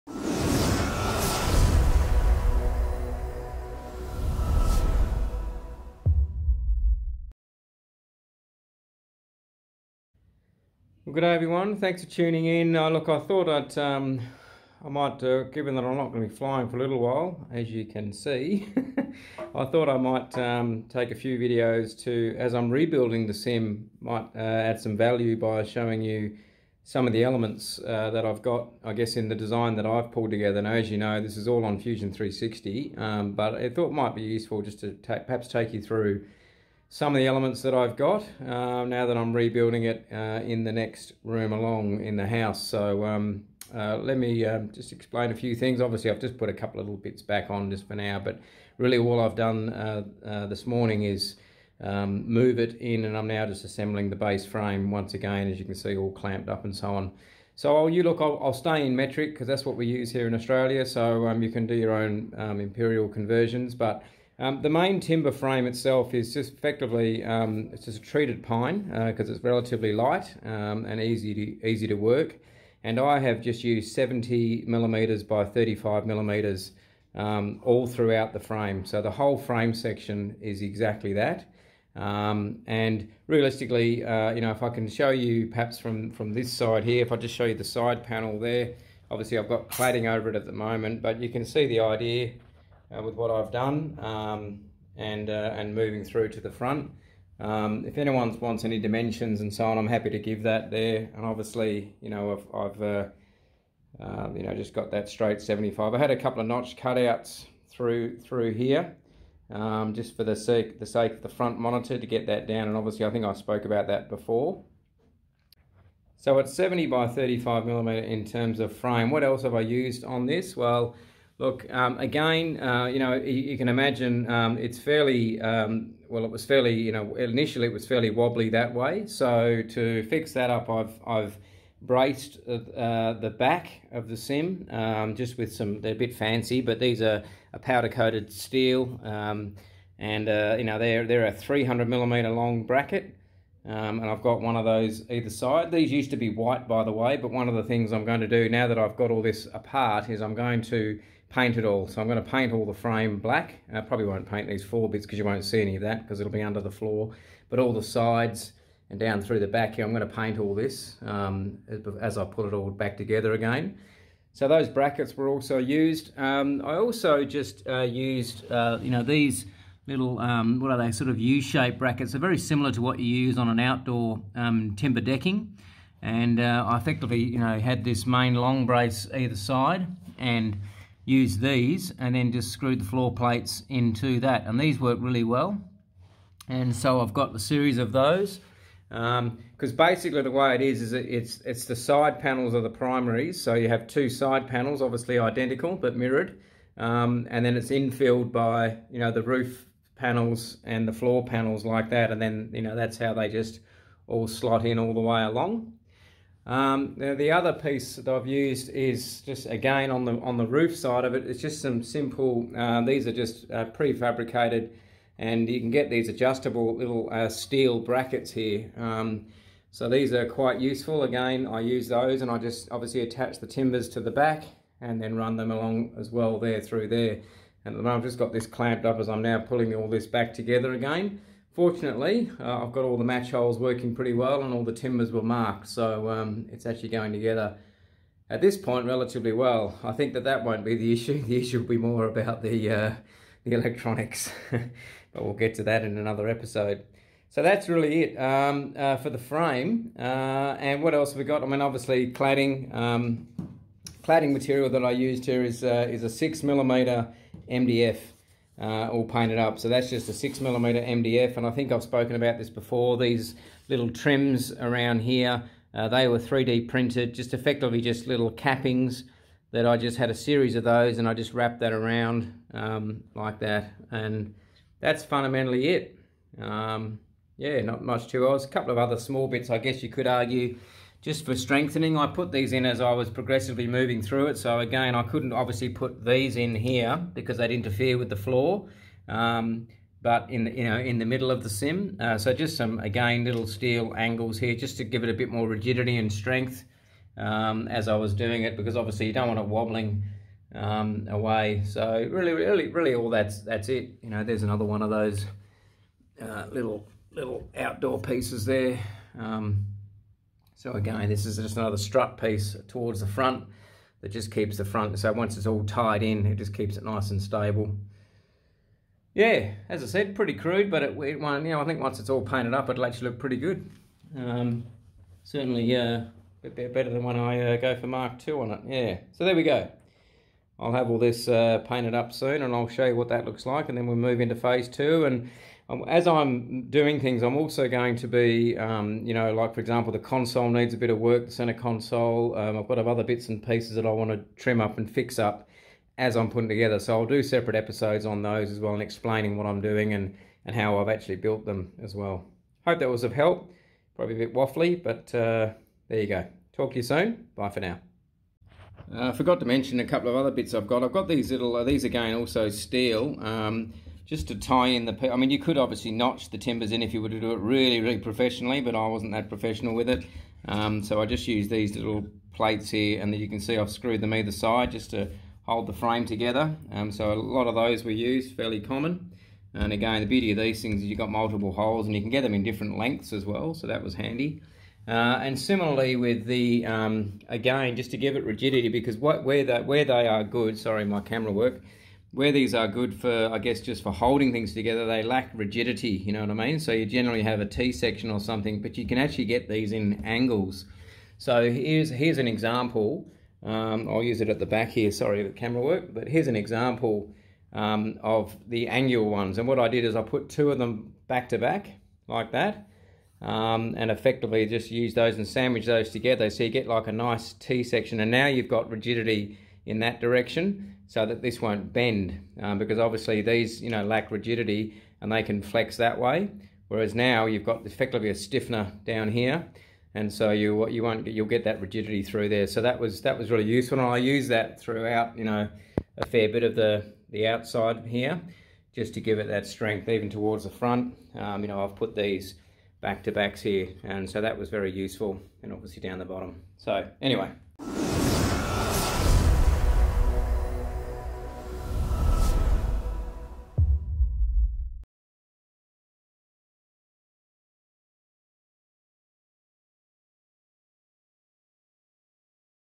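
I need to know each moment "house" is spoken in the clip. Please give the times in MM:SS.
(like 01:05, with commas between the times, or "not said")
00:42.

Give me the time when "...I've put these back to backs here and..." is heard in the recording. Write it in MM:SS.
07:21.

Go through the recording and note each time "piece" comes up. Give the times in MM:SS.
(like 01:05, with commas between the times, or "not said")
03:27, 05:08, 05:12, 05:43.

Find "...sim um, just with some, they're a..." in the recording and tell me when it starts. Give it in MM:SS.
02:14.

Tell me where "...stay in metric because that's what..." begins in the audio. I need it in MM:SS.
00:58.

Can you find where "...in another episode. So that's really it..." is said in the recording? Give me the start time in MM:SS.
04:05.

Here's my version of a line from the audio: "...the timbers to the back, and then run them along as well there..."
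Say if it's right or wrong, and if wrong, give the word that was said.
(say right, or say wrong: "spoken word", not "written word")
right.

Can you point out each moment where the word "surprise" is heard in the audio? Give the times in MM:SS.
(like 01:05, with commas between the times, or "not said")
not said.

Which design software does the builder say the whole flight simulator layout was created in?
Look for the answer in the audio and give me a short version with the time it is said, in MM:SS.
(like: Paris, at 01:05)
Fusion 360, at 00:31.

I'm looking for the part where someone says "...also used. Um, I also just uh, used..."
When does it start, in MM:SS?
02:45.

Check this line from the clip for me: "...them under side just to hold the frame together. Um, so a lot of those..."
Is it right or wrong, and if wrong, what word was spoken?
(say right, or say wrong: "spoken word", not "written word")
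wrong: "either", not "under".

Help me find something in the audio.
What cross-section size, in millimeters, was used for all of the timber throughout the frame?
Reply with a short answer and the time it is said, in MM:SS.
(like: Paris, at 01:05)
70 by 35 mm, at 01:13.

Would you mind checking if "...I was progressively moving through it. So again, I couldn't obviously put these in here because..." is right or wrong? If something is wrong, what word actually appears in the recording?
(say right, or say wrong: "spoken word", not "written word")
right.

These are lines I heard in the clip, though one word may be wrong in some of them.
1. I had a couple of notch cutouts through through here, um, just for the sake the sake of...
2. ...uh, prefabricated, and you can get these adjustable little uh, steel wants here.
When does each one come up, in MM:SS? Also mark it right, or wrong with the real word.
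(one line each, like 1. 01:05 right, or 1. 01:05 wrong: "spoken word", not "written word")
1. 01:45 right
2. 03:33 wrong: "brackets", not "wants".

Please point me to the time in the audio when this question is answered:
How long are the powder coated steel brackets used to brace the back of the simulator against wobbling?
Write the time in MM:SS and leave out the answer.
02:21.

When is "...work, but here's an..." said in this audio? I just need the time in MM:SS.
06:45.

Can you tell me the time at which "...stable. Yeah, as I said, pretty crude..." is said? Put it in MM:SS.
05:17.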